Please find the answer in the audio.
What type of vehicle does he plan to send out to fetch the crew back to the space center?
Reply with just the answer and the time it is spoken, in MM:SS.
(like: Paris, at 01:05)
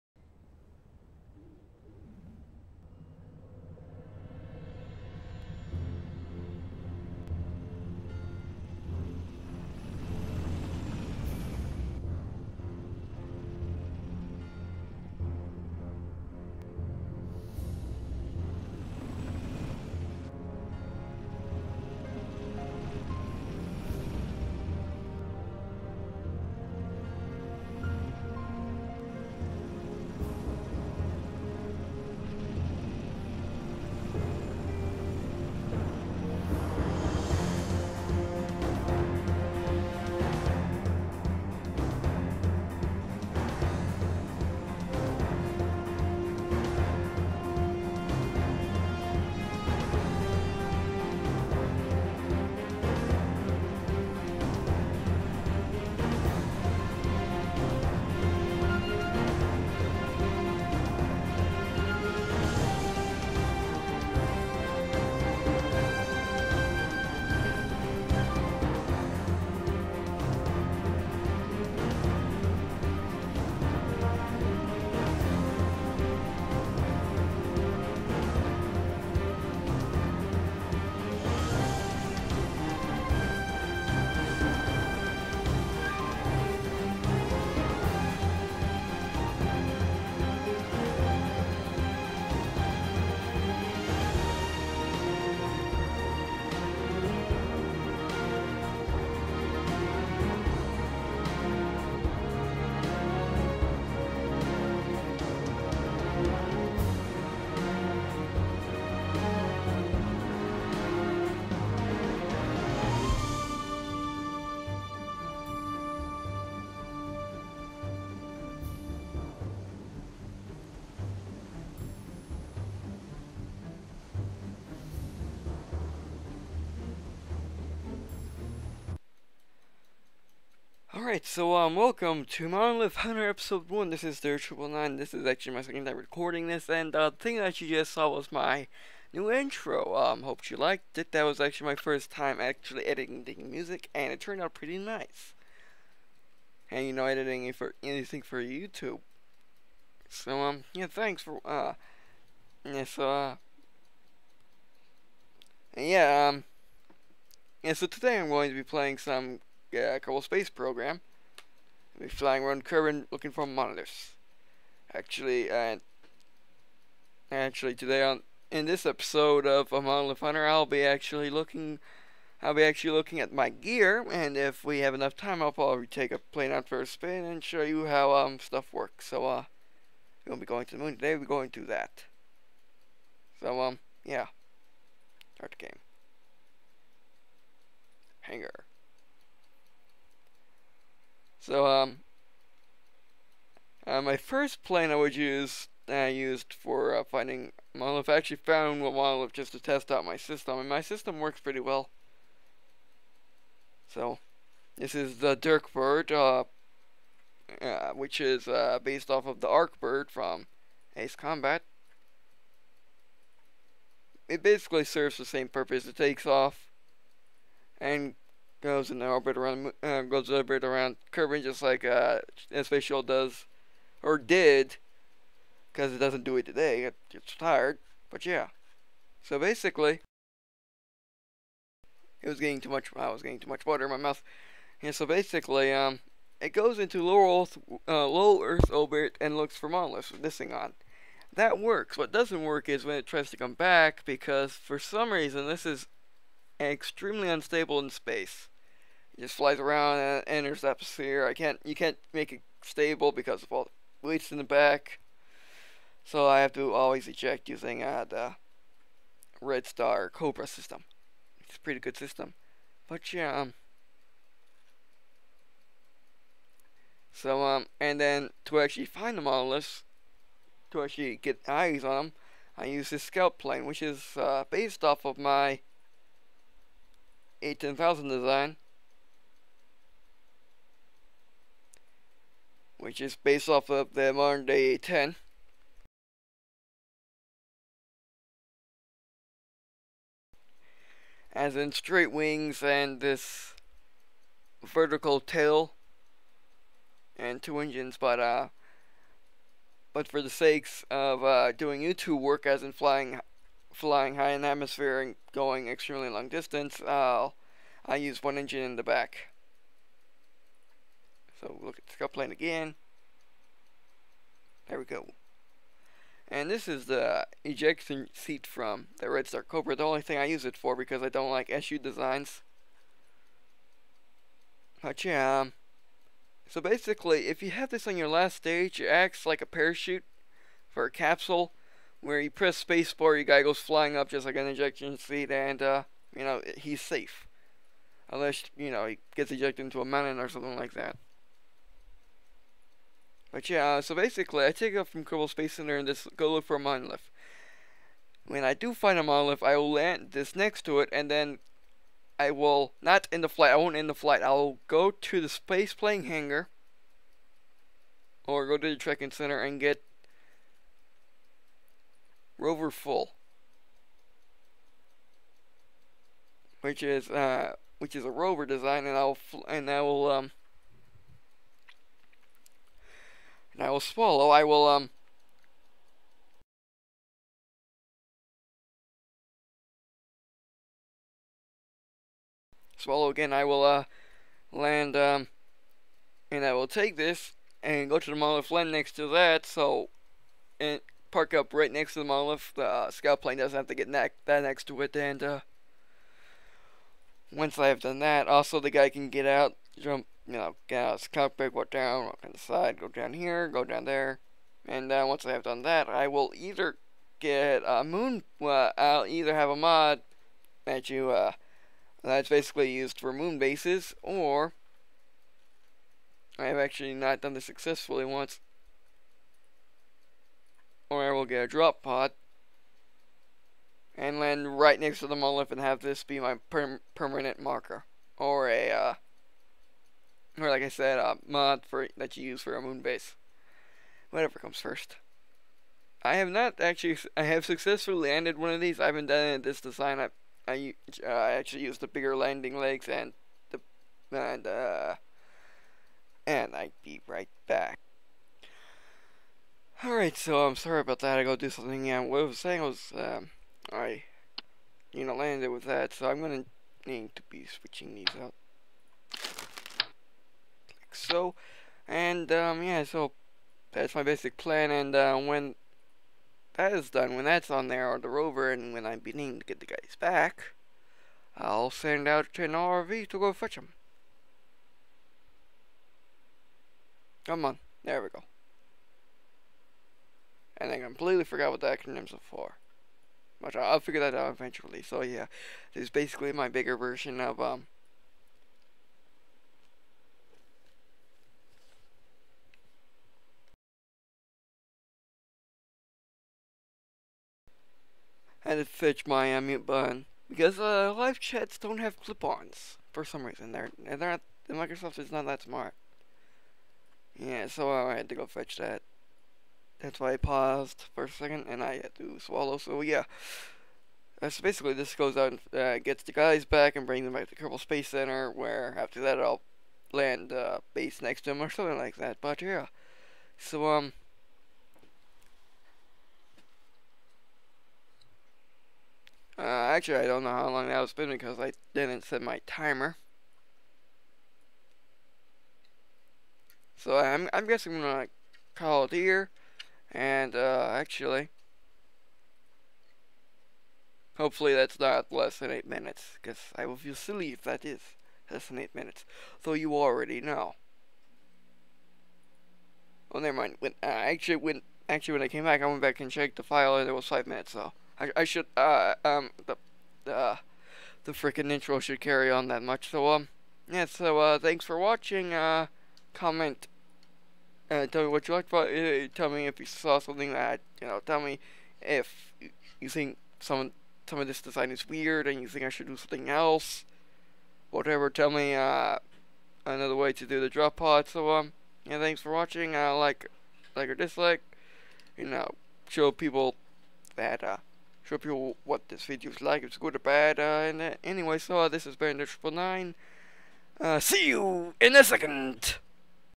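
RV, at 07:52.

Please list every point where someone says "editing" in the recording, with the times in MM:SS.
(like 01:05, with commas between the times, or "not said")
02:22, 02:27.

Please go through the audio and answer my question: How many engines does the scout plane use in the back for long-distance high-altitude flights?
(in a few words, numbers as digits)
1.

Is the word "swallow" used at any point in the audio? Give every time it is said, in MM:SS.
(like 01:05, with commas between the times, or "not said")
06:13, 06:22, 08:32.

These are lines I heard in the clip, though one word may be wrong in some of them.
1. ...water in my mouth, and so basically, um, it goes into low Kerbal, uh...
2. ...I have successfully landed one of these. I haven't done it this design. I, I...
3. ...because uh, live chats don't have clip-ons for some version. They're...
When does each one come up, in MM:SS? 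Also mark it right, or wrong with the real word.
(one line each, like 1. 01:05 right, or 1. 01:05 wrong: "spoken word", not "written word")
1. 03:53 wrong: "Earth", not "Kerbal"
2. 07:17 right
3. 08:20 wrong: "reason", not "version".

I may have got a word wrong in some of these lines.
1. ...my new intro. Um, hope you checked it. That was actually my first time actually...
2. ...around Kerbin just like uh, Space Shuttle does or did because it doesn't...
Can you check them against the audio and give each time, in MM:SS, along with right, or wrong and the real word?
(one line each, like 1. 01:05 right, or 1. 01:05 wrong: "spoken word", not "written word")
1. 02:18 wrong: "liked", not "checked"
2. 03:40 right.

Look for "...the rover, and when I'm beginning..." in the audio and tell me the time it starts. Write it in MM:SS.
07:48.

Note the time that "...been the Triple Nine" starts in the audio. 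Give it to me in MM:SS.
09:51.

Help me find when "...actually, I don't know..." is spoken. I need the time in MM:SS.
08:49.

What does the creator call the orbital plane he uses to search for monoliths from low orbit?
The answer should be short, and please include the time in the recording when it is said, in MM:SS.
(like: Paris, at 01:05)
Dirk bird, at 03:25.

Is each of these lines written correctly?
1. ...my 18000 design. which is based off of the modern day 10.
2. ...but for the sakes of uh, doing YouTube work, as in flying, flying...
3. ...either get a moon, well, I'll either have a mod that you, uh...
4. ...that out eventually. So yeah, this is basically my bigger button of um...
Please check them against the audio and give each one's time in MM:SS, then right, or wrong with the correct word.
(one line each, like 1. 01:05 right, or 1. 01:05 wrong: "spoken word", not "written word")
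1. 04:35 right
2. 04:59 right
3. 06:46 right
4. 08:04 wrong: "version", not "button".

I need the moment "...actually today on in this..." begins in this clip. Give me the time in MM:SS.
02:47.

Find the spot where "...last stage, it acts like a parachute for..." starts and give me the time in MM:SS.
05:28.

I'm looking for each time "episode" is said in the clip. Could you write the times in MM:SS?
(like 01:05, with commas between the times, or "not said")
02:13, 02:48.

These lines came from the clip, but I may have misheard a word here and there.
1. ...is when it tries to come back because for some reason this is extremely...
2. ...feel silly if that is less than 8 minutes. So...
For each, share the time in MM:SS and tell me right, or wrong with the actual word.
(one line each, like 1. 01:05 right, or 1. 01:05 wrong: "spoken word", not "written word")
1. 04:02 right
2. 09:06 right.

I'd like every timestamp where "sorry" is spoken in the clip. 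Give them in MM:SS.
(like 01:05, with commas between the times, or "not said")
07:30.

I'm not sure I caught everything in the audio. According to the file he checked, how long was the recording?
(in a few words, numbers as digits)
5.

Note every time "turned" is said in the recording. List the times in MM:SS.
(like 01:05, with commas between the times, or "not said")
02:24.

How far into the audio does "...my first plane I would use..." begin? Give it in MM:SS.
03:14.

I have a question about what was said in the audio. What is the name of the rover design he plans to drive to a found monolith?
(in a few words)
rover full.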